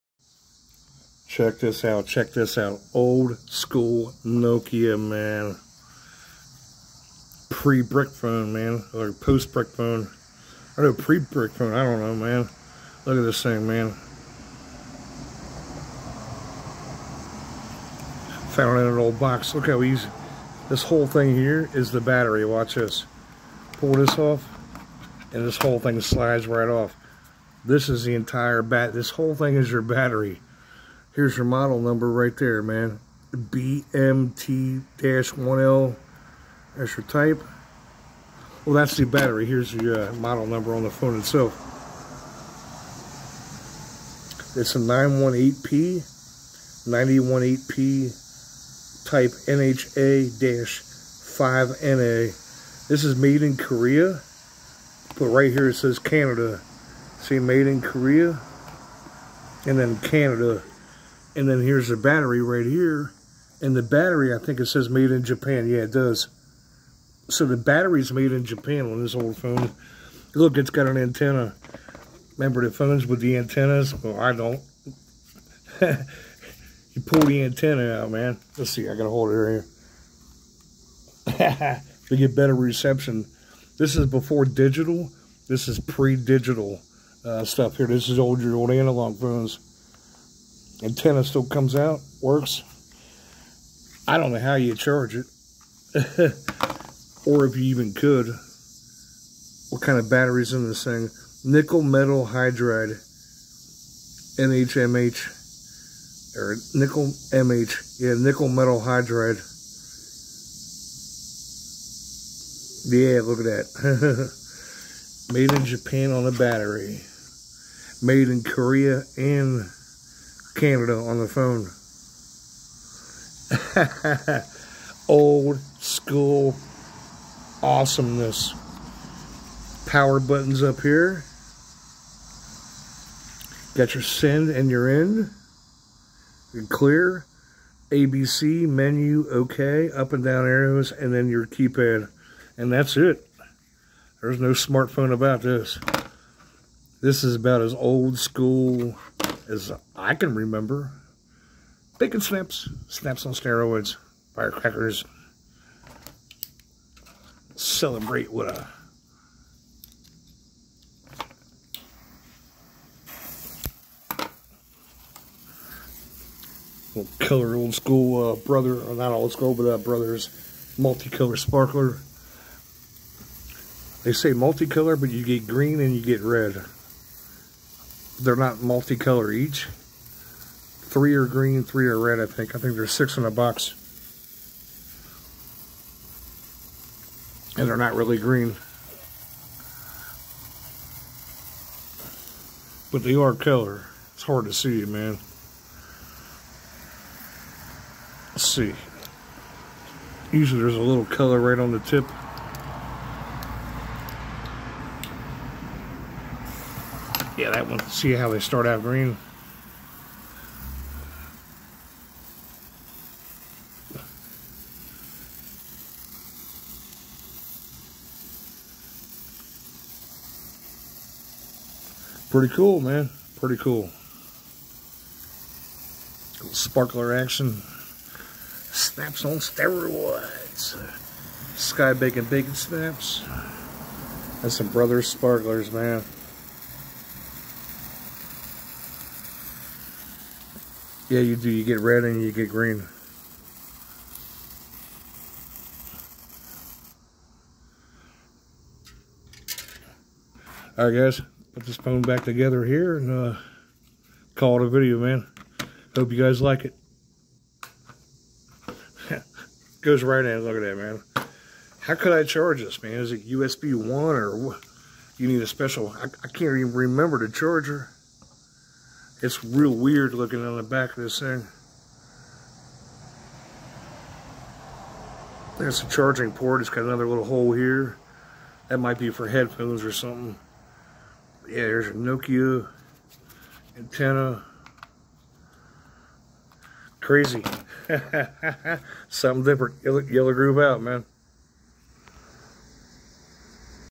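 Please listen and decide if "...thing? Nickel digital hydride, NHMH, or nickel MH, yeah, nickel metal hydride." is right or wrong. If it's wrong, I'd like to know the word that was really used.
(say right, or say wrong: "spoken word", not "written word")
wrong: "metal", not "digital".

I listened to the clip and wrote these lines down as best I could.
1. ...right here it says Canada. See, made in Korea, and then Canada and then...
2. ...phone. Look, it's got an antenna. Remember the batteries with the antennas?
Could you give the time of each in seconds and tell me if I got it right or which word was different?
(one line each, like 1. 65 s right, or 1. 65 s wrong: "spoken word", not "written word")
1. 55 s right
2. 69 s wrong: "phones", not "batteries".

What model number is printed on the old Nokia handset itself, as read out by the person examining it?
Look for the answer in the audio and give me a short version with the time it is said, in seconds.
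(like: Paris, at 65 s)
918P, at 44 s.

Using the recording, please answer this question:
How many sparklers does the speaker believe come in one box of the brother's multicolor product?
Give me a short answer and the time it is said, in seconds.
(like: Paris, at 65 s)
6, at 182 s.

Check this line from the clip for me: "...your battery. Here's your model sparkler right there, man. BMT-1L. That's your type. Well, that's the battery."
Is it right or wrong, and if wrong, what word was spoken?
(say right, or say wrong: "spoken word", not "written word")
wrong: "number", not "sparkler".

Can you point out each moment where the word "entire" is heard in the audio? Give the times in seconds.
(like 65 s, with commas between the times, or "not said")
28 s.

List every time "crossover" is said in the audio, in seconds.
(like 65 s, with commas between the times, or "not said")
not said.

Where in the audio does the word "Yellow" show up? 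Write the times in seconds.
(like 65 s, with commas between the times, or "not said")
289 s.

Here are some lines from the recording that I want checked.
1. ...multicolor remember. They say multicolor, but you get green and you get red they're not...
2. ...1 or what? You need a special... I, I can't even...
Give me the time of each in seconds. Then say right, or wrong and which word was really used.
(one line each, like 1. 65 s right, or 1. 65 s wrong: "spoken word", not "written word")
1. 170 s wrong: "sparkler", not "remember"
2. 263 s right.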